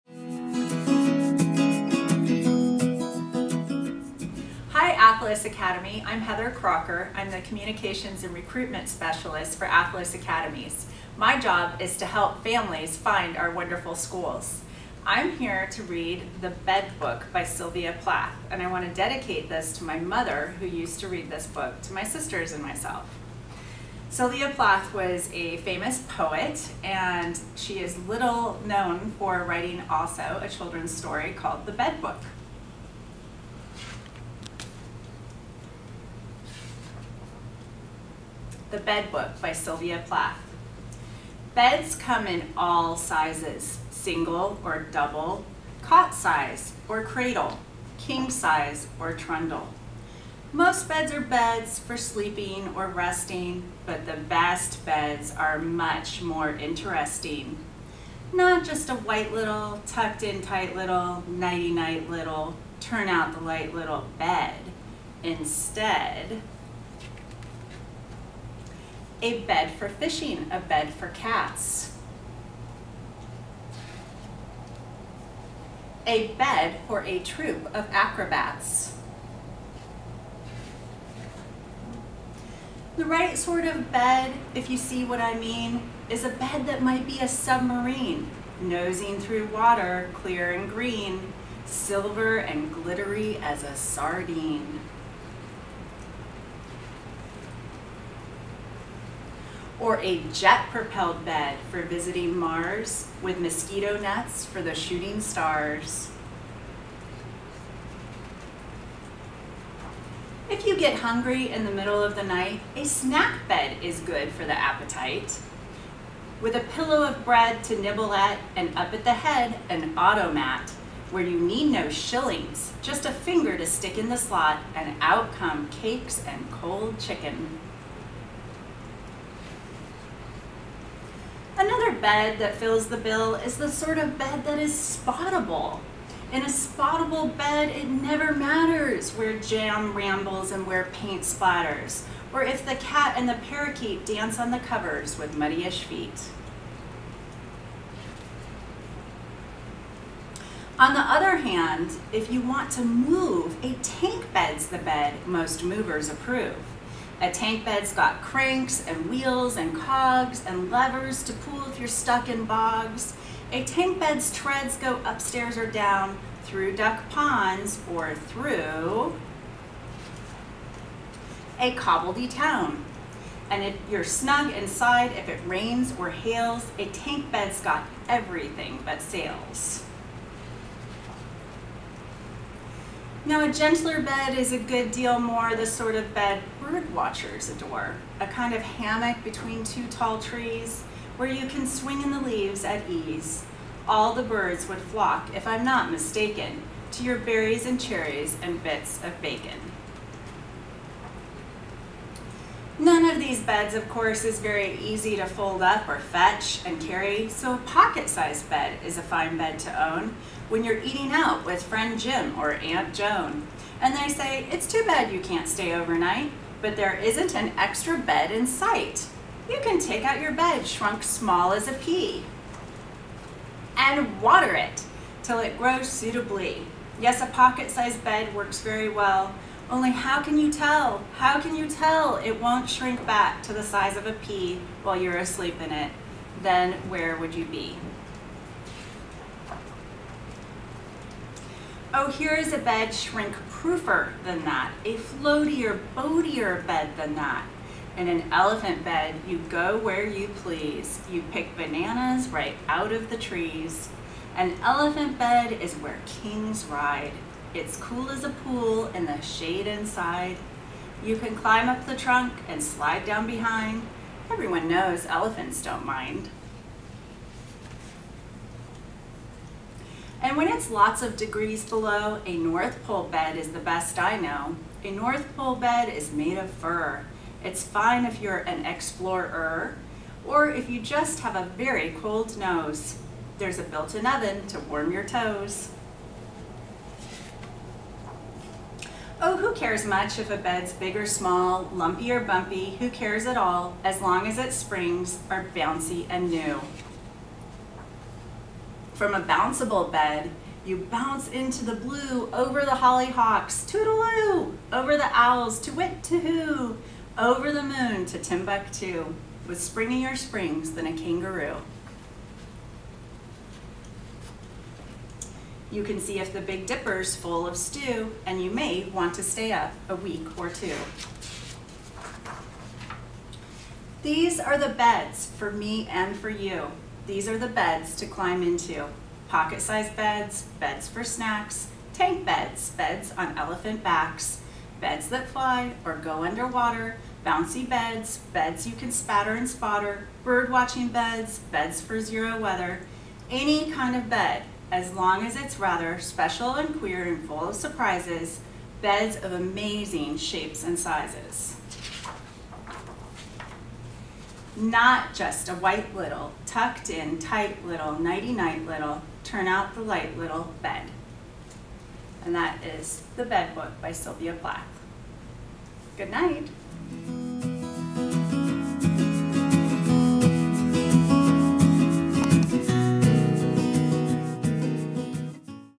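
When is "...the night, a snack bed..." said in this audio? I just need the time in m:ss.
1:52.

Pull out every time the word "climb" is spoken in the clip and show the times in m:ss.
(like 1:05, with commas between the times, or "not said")
4:21, 5:28.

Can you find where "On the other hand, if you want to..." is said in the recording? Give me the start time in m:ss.
2:30.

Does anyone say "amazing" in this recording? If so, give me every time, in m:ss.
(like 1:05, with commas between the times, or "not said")
5:49.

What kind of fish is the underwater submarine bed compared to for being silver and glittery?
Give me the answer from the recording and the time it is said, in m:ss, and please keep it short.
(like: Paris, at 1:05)
sardine, at 1:33.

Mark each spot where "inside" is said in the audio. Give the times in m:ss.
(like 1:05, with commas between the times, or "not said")
2:54, 4:19.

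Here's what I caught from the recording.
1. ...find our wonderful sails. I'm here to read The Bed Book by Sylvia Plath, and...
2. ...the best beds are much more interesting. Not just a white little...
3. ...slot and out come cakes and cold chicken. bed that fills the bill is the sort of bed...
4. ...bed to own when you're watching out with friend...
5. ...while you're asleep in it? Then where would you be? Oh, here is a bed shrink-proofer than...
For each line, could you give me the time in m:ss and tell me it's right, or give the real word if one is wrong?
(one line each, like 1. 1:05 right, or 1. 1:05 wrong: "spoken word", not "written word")
1. 0:12 wrong: "schools", not "sails"
2. 0:54 right
3. 2:04 right
4. 3:29 wrong: "eating", not "watching"
5. 3:54 right.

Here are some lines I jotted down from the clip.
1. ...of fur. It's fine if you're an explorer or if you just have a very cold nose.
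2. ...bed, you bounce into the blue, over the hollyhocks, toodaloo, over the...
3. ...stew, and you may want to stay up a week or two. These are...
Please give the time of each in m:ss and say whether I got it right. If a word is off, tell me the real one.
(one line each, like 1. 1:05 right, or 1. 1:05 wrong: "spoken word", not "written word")
1. 4:36 right
2. 4:59 right
3. 5:17 right.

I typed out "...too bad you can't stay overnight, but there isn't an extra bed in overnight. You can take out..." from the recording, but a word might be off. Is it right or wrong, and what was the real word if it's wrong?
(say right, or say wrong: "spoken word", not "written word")
wrong: "sight", not "overnight".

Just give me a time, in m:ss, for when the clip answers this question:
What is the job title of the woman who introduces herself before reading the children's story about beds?
0:07.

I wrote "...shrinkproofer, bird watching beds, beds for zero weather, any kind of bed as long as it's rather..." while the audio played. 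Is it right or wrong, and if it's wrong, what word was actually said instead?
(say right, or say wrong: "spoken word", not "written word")
wrong: "spotter", not "shrinkproofer".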